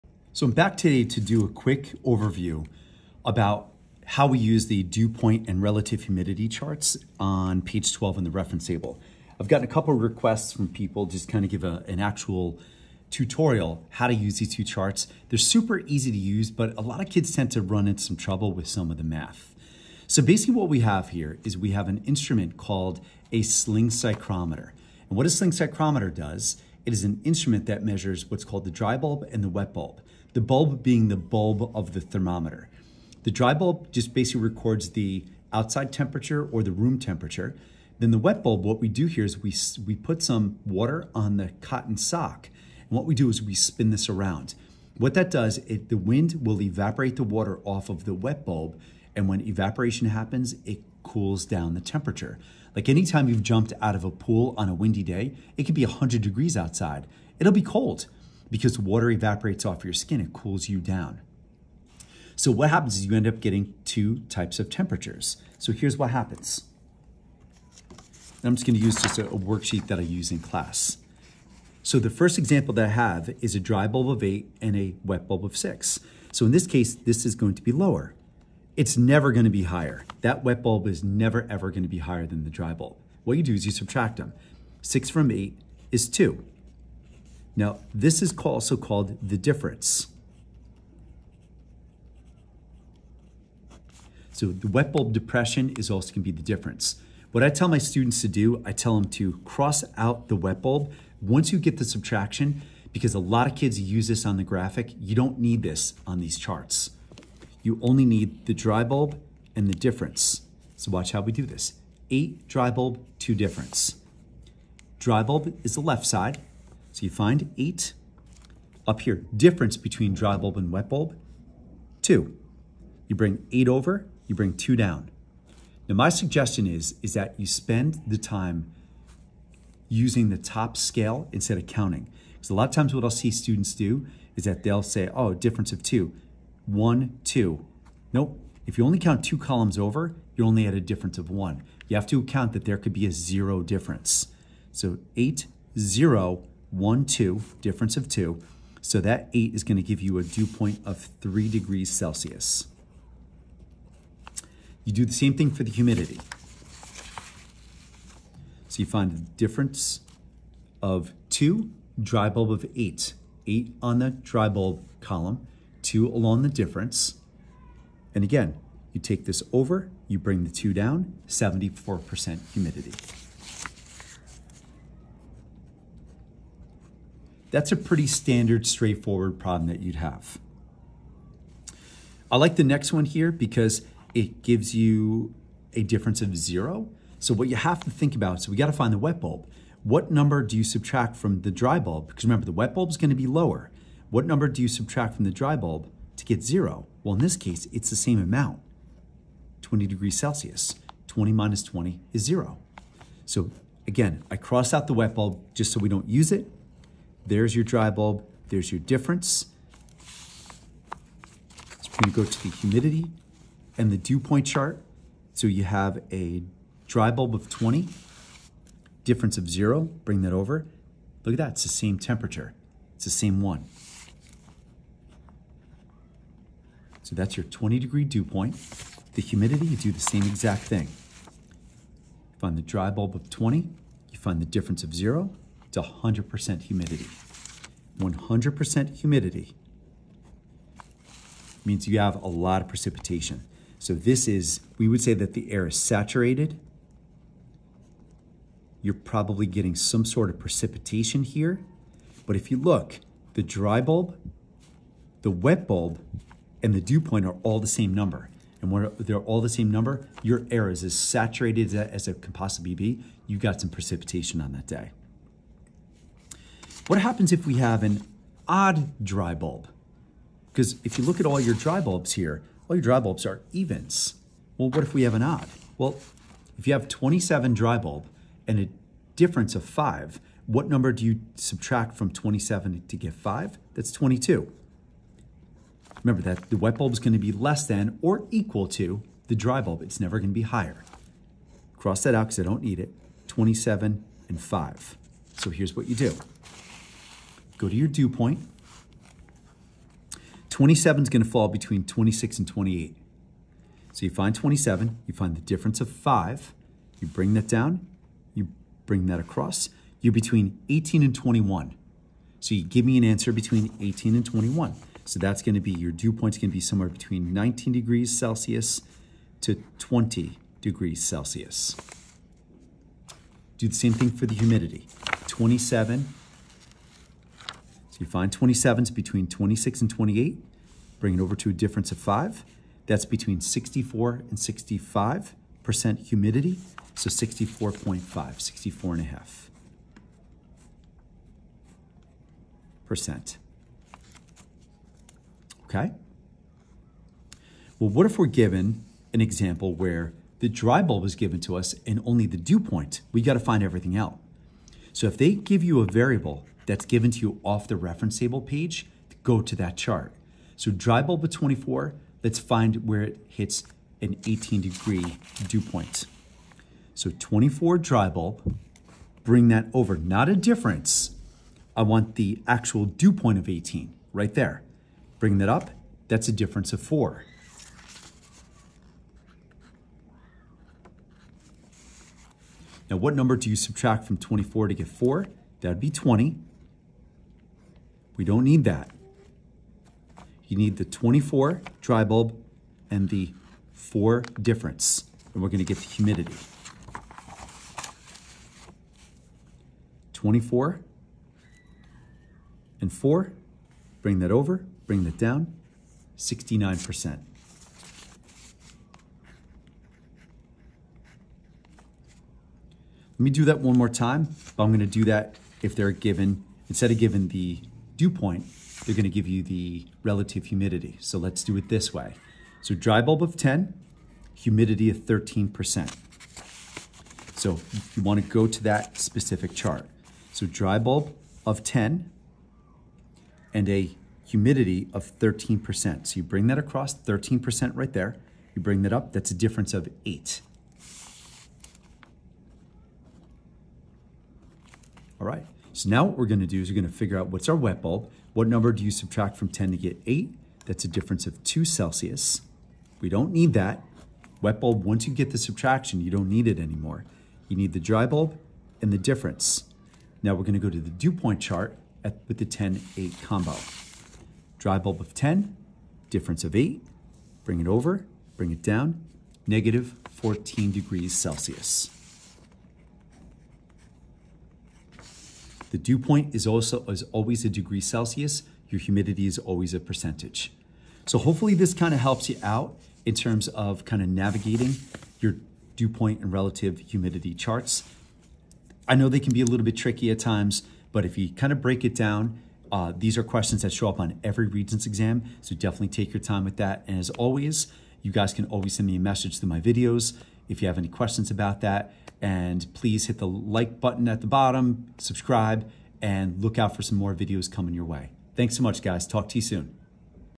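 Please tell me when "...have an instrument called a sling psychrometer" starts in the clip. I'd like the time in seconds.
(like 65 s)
21 s.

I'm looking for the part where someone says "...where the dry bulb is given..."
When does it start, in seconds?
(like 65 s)
349 s.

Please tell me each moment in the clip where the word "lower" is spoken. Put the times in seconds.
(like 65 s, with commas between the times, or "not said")
77 s, 193 s.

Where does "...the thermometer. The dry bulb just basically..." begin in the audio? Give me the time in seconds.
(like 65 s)
31 s.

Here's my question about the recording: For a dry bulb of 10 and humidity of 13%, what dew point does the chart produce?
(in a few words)
-14 degrees Celsius.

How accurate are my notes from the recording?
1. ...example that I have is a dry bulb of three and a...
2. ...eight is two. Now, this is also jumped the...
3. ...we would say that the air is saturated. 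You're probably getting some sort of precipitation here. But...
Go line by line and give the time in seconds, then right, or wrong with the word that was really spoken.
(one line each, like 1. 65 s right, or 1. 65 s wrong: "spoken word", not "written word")
1. 72 s wrong: "eight", not "three"
2. 85 s wrong: "called", not "jumped"
3. 244 s right.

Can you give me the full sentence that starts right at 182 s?
I like the next one here because it gives you a difference of zero.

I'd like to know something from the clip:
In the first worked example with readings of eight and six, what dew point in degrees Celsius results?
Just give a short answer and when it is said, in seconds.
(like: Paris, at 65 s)
3 degrees Celsius, at 150 s.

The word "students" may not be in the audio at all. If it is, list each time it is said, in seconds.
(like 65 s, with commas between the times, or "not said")
97 s, 133 s.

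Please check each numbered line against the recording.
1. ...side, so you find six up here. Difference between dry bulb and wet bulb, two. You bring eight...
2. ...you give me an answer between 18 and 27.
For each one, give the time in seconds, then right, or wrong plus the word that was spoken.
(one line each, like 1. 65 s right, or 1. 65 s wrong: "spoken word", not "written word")
1. 116 s wrong: "eight", not "six"
2. 312 s wrong: "21", not "27".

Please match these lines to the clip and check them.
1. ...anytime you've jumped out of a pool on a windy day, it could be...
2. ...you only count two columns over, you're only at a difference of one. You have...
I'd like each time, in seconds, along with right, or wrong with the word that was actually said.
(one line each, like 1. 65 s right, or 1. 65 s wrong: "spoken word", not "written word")
1. 52 s right
2. 138 s right.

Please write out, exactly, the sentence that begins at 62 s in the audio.
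So what happens is you end up getting two types of temperatures.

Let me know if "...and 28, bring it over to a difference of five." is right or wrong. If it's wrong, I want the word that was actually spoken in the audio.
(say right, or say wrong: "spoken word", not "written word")
right.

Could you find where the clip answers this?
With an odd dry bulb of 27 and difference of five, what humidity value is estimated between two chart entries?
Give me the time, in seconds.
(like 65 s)
337 s.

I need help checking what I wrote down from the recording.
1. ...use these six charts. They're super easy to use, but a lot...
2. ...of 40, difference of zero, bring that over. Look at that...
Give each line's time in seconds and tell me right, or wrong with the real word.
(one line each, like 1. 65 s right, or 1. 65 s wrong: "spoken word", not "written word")
1. 14 s wrong: "two", not "six"
2. 217 s wrong: "20", not "40".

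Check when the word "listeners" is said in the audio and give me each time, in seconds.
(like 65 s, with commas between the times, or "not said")
not said.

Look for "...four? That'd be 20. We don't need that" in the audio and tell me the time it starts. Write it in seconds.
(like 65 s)
384 s.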